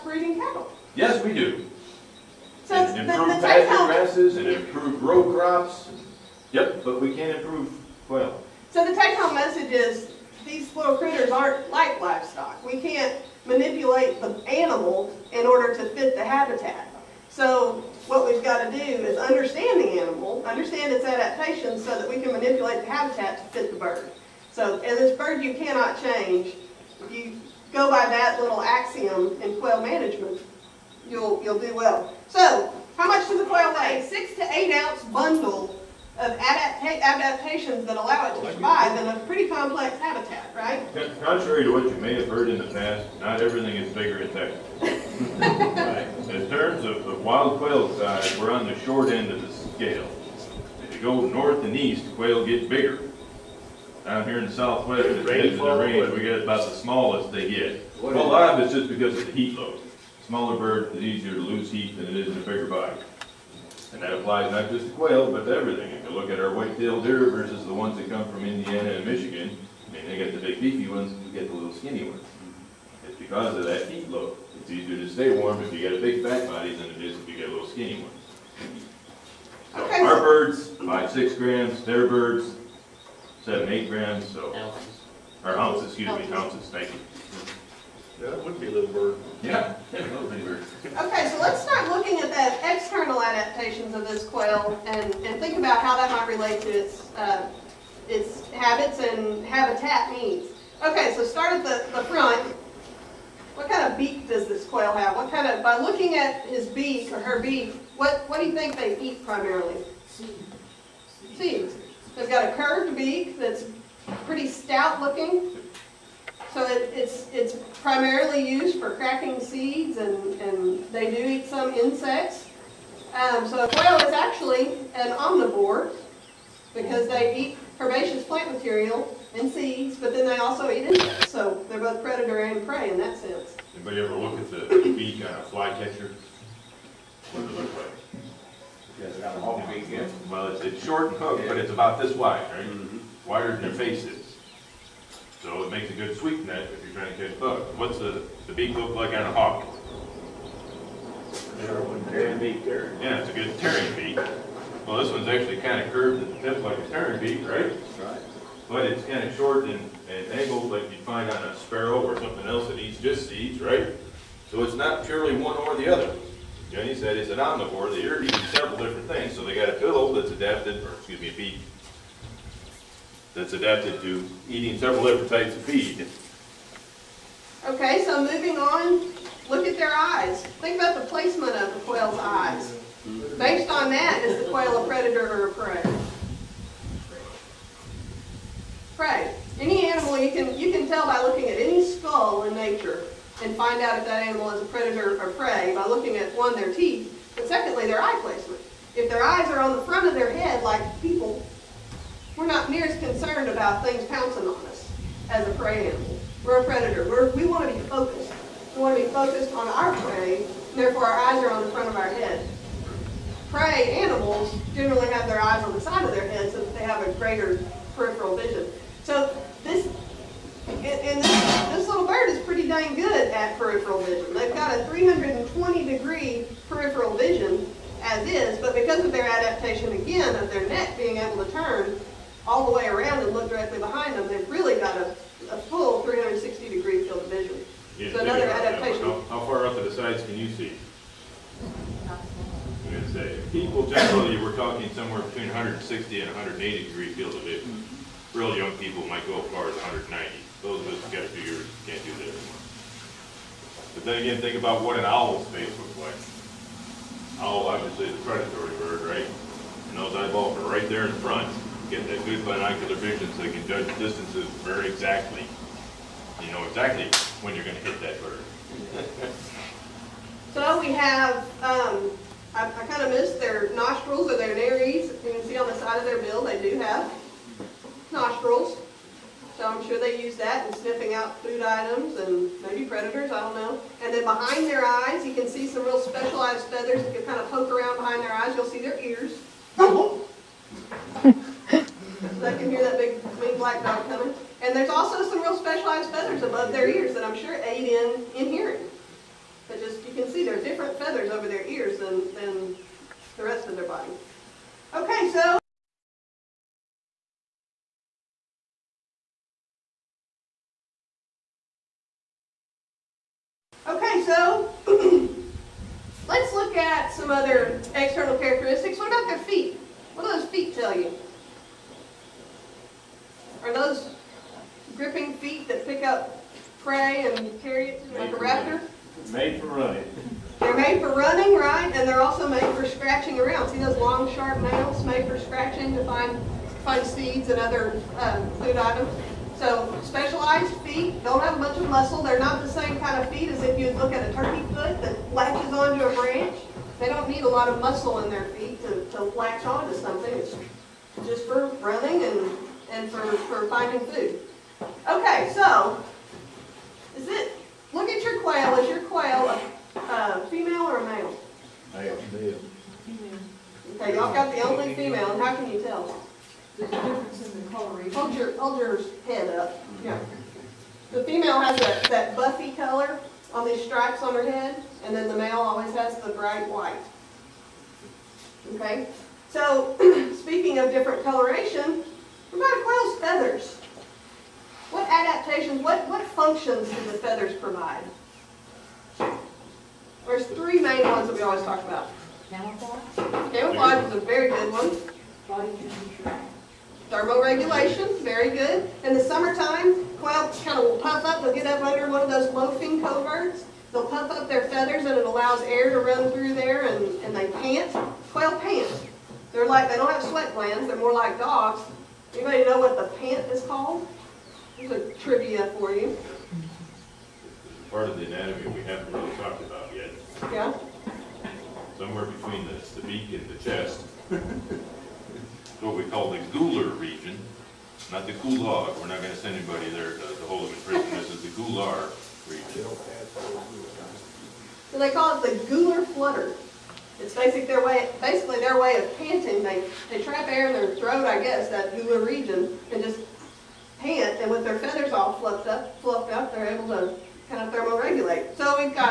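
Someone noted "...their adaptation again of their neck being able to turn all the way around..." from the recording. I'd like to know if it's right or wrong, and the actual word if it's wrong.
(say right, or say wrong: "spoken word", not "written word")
right.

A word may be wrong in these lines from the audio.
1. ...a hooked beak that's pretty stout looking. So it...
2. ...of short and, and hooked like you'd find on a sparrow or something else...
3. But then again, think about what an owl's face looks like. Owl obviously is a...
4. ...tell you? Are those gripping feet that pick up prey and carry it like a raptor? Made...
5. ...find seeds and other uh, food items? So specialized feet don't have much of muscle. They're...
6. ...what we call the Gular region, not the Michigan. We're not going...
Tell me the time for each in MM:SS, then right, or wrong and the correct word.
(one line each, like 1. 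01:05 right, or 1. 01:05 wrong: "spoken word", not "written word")
1. 01:52 wrong: "curved", not "hooked"
2. 02:39 wrong: "angled", not "hooked"
3. 04:13 right
4. 05:20 right
5. 05:36 right
6. 07:05 wrong: "Gulag", not "Michigan".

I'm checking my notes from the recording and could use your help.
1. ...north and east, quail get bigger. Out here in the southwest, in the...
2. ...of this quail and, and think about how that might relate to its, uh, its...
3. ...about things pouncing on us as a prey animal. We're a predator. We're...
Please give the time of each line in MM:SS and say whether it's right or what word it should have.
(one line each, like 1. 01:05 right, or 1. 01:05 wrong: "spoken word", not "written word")
1. 00:51 right
2. 01:33 right
3. 03:23 right.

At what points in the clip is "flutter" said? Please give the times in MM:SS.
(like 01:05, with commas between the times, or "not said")
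07:16.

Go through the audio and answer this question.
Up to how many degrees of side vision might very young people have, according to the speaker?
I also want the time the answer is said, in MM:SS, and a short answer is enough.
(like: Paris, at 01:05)
190, at 04:09.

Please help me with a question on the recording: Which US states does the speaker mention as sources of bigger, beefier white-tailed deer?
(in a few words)
Indiana and Michigan.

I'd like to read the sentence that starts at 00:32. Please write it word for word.
So, how much does a quail weigh?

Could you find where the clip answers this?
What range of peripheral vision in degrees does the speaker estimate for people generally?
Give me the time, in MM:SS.
04:05.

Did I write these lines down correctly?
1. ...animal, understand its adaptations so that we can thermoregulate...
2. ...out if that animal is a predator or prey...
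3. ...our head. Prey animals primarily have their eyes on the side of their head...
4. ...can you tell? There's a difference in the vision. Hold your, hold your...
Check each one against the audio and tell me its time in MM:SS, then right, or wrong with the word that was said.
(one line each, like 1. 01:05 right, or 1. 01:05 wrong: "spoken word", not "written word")
1. 00:20 wrong: "manipulate", not "thermoregulate"
2. 03:13 right
3. 03:31 wrong: "generally", not "primarily"
4. 06:05 wrong: "coloration", not "vision".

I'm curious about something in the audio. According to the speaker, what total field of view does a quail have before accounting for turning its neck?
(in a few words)
320 degrees.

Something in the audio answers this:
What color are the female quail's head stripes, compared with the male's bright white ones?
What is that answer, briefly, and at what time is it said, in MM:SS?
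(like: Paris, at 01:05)
buffy, at 06:12.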